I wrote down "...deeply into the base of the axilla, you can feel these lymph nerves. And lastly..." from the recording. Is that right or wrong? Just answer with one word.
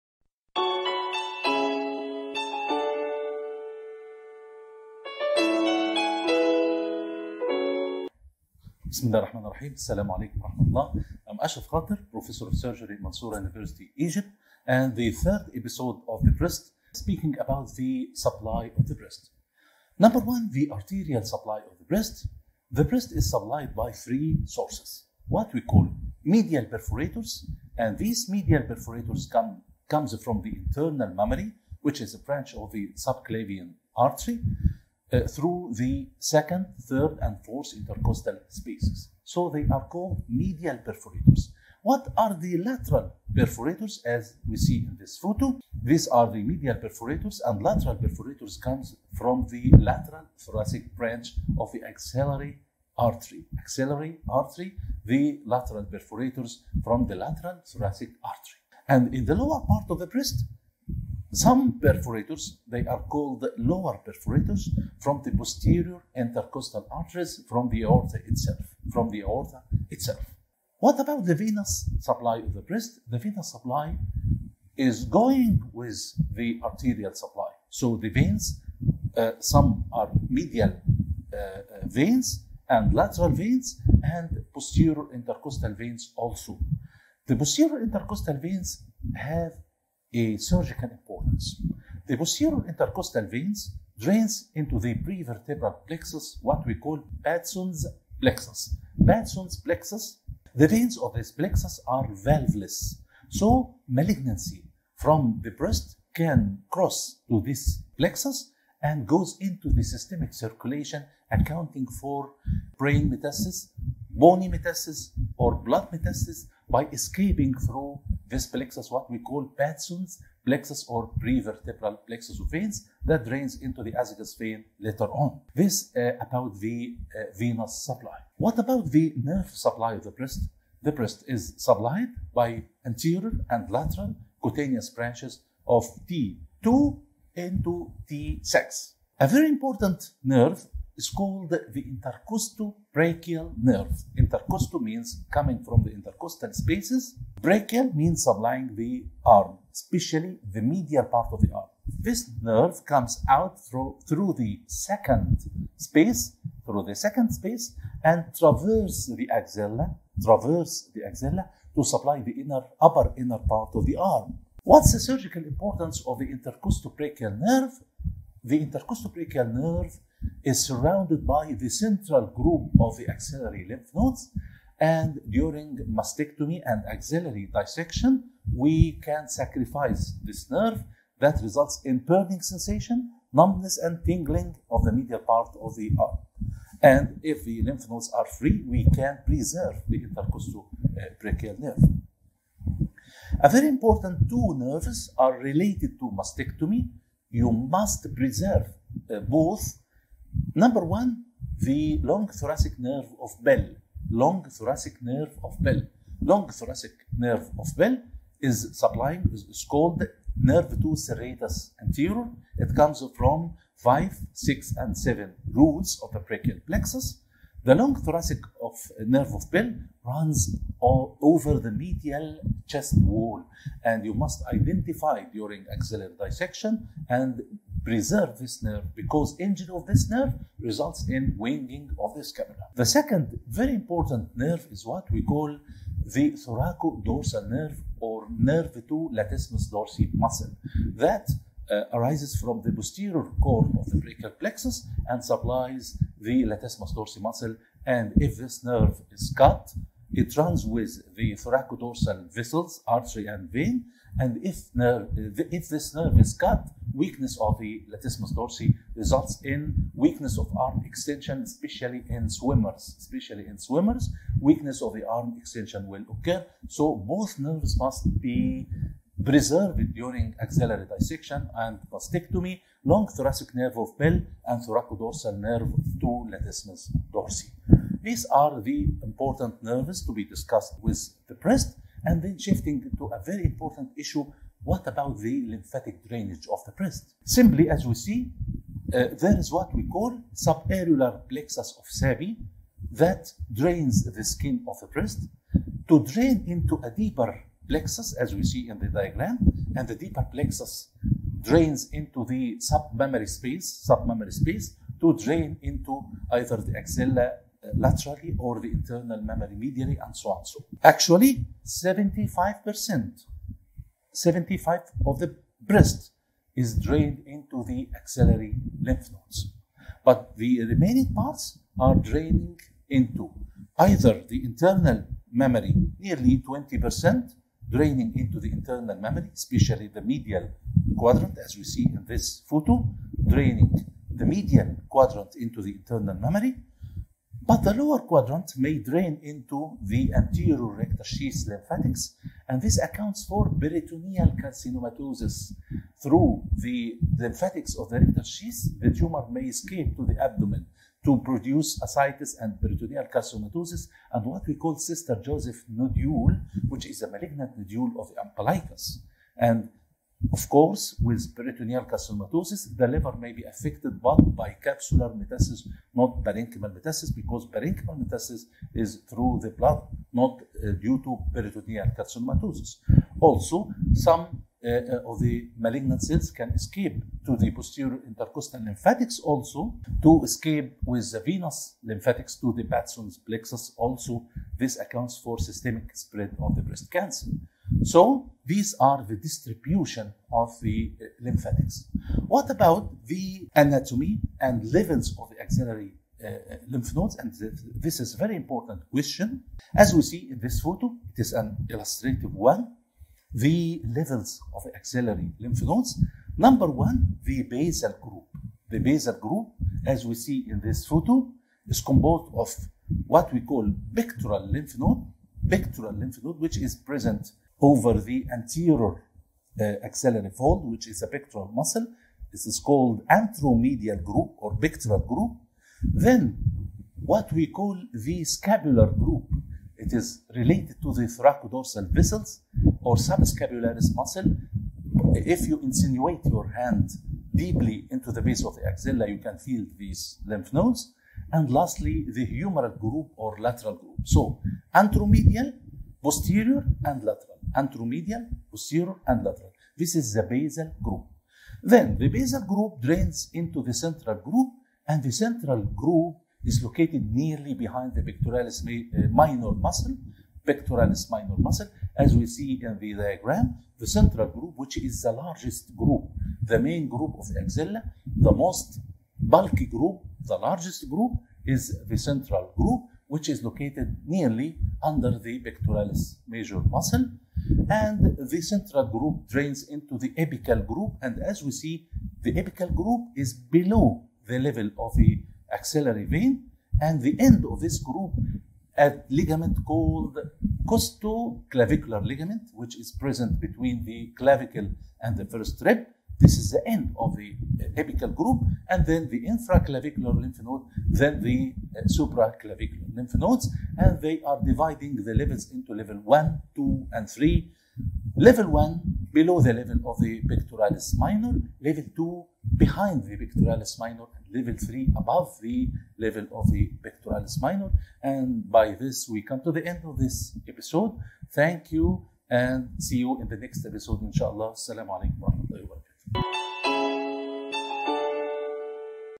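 wrong.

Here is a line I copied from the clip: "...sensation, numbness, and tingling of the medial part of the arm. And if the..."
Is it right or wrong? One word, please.
right.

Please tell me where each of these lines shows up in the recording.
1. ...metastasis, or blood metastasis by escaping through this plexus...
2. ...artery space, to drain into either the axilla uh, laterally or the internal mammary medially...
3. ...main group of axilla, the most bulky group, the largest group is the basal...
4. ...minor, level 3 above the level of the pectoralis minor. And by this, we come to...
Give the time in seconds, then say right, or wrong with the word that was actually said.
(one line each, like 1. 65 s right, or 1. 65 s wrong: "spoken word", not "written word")
1. 114 s right
2. 303 s wrong: "submammary", not "artery"
3. 466 s wrong: "central", not "basal"
4. 513 s right.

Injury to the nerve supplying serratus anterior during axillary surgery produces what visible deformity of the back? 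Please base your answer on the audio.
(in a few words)
winging of the scapula.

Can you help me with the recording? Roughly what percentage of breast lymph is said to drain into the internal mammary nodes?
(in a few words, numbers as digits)
20%.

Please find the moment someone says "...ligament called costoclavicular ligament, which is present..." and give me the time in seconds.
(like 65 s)
489 s.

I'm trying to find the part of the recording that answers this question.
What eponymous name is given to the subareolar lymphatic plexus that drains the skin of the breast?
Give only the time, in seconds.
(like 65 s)
291 s.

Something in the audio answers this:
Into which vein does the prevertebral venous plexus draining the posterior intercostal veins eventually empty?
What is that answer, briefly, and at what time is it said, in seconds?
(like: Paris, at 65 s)
azygous vein, at 123 s.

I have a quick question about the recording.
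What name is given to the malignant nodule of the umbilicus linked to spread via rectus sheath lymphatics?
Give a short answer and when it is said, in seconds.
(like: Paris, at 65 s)
Sister Joseph nodule, at 354 s.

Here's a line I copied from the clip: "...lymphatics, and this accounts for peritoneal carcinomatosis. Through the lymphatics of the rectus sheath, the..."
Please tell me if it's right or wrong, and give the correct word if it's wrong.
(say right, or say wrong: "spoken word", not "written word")
right.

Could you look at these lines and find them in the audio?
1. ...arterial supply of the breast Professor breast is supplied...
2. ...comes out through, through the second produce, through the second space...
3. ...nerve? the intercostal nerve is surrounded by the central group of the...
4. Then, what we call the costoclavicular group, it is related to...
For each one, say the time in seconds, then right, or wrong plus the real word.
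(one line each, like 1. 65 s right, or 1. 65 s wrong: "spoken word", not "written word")
1. 20 s wrong: "The", not "Professor"
2. 152 s wrong: "space", not "produce"
3. 167 s right
4. 425 s wrong: "scapular", not "costoclavicular".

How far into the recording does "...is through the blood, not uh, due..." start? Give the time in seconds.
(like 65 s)
368 s.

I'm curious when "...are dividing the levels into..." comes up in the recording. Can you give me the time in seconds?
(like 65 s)
504 s.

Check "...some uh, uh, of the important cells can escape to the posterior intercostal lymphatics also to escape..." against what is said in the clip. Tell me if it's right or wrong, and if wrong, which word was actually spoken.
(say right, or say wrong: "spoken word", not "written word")
wrong: "malignant", not "important".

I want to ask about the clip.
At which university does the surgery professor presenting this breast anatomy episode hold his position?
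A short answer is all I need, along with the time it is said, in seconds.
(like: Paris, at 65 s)
Mansoura University, at 13 s.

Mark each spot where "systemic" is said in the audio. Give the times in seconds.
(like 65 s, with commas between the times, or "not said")
109 s, 385 s.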